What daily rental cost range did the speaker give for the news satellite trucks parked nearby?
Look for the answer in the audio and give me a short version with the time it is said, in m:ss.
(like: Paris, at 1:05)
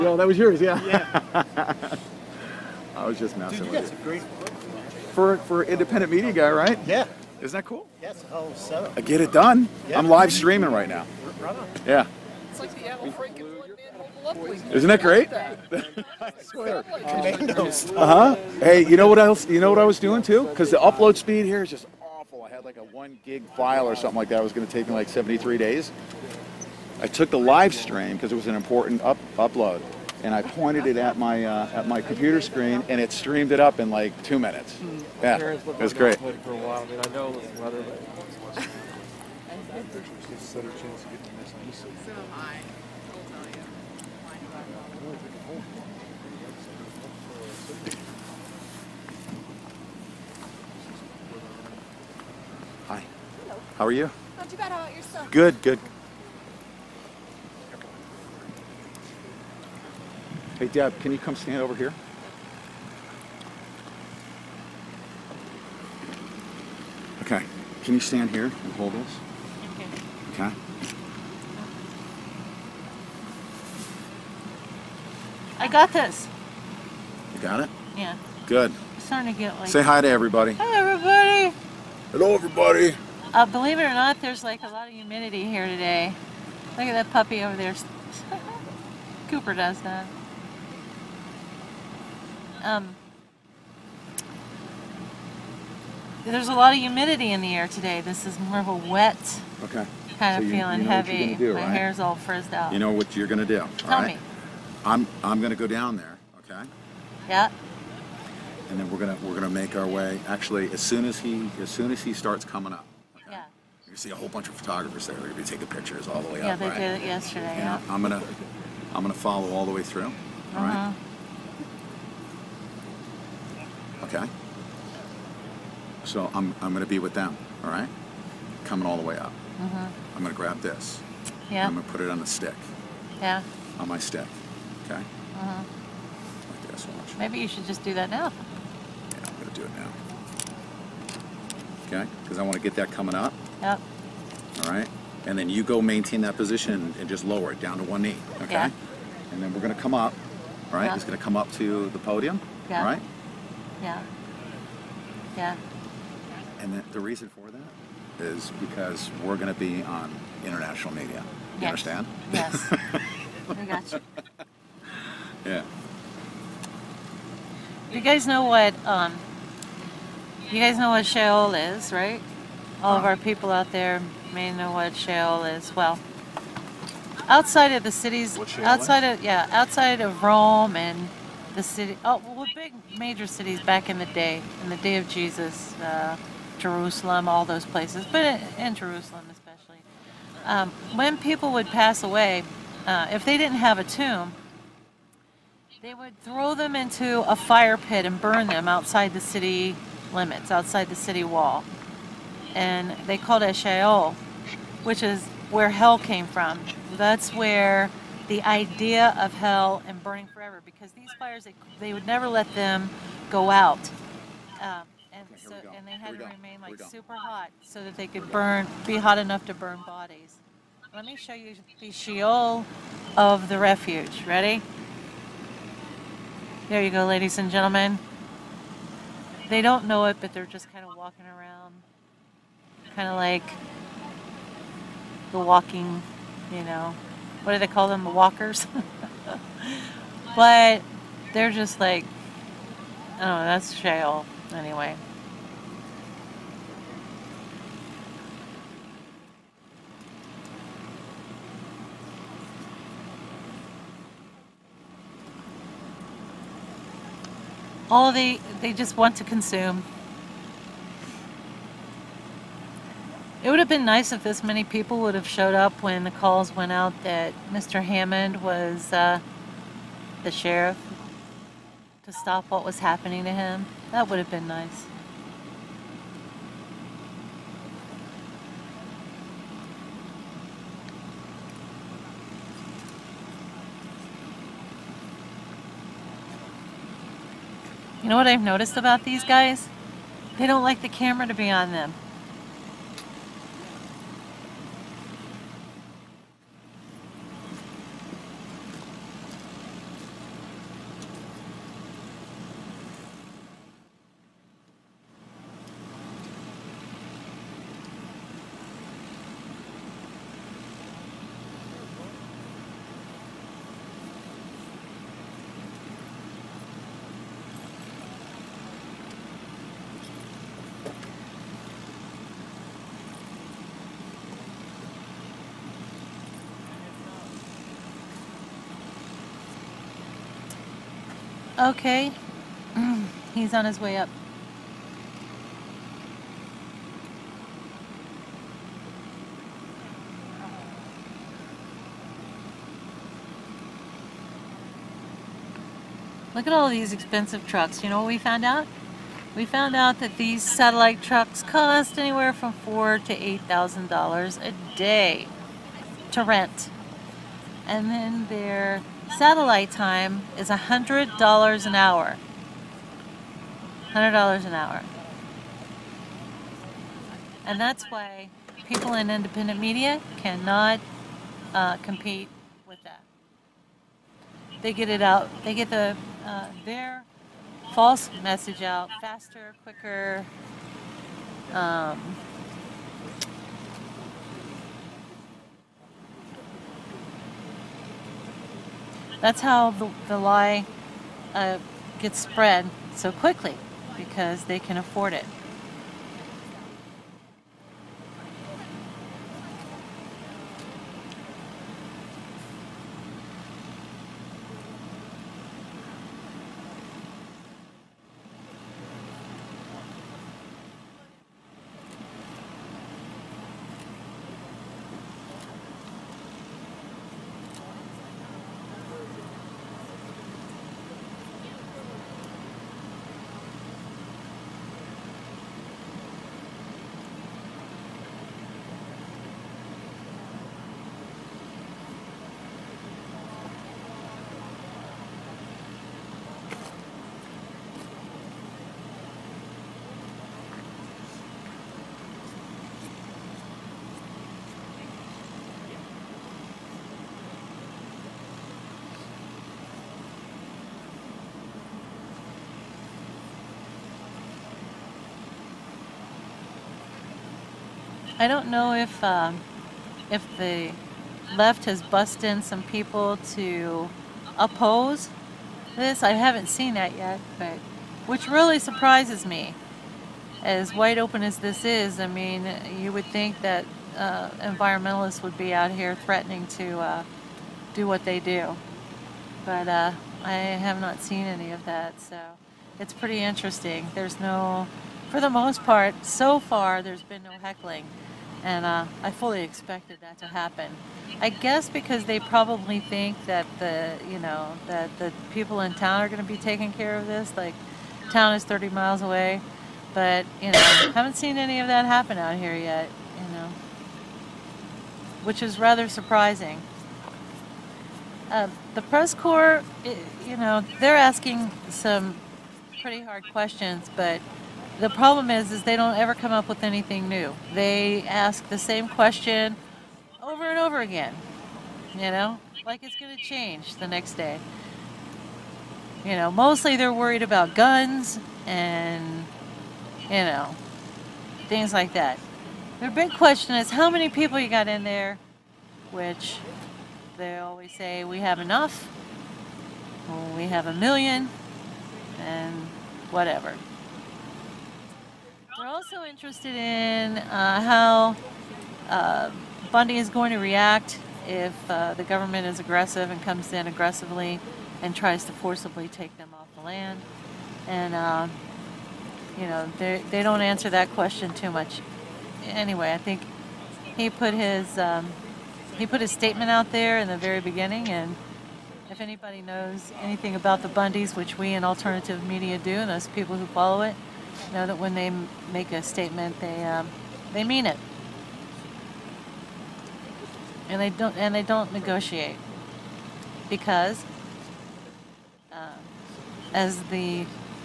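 $4,000 to $8,000, at 5:52.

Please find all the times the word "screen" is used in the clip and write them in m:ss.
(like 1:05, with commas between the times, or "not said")
0:32.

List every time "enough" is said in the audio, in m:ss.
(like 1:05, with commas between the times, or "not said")
3:39, 8:58.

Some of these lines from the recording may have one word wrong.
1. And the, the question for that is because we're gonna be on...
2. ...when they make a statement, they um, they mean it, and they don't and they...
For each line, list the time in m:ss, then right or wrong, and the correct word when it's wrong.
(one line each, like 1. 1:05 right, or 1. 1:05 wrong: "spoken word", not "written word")
1. 2:36 wrong: "reason", not "question"
2. 9:34 right.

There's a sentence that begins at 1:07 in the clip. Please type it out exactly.
Can you stand here and hold this?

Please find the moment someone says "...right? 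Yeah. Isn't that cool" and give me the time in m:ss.
0:06.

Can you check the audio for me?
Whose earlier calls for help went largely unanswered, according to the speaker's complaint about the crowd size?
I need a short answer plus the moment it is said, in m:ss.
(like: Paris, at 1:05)
Mr. Hammond, at 4:27.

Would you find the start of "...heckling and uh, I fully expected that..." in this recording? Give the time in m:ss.
8:07.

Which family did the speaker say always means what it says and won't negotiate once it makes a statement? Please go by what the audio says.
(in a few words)
The Bundys.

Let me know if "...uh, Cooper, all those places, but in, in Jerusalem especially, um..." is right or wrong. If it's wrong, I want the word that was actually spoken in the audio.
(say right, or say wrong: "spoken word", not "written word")
wrong: "Jerusalem", not "Cooper".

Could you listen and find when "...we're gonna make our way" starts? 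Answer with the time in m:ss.
1:49.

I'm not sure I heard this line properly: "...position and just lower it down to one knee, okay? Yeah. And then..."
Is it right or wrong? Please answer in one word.
right.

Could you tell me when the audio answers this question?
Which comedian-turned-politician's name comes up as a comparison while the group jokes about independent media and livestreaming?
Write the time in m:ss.
0:12.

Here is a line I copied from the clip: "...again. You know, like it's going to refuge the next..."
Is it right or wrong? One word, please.
wrong.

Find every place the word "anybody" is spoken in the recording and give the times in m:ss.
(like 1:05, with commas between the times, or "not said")
9:28.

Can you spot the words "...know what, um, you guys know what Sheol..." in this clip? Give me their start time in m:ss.
2:48.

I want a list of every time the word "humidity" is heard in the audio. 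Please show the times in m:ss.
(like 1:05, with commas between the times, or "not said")
1:24, 1:36.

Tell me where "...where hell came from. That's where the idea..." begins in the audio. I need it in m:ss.
3:25.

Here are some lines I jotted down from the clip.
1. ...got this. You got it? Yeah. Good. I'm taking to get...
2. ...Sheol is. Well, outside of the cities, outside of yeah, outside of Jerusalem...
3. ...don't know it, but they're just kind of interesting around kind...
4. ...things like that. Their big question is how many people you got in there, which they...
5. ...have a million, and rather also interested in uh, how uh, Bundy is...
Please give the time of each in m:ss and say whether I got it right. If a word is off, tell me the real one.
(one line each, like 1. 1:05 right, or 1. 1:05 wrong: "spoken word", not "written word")
1. 1:15 wrong: "starting", not "taking"
2. 2:54 wrong: "Rome", not "Jerusalem"
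3. 3:49 wrong: "walking", not "interesting"
4. 8:51 right
5. 9:00 wrong: "whatever", not "rather".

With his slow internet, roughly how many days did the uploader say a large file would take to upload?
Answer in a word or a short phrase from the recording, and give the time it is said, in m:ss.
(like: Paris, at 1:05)
73 days, at 0:25.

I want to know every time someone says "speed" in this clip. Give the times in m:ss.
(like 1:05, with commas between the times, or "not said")
0:21.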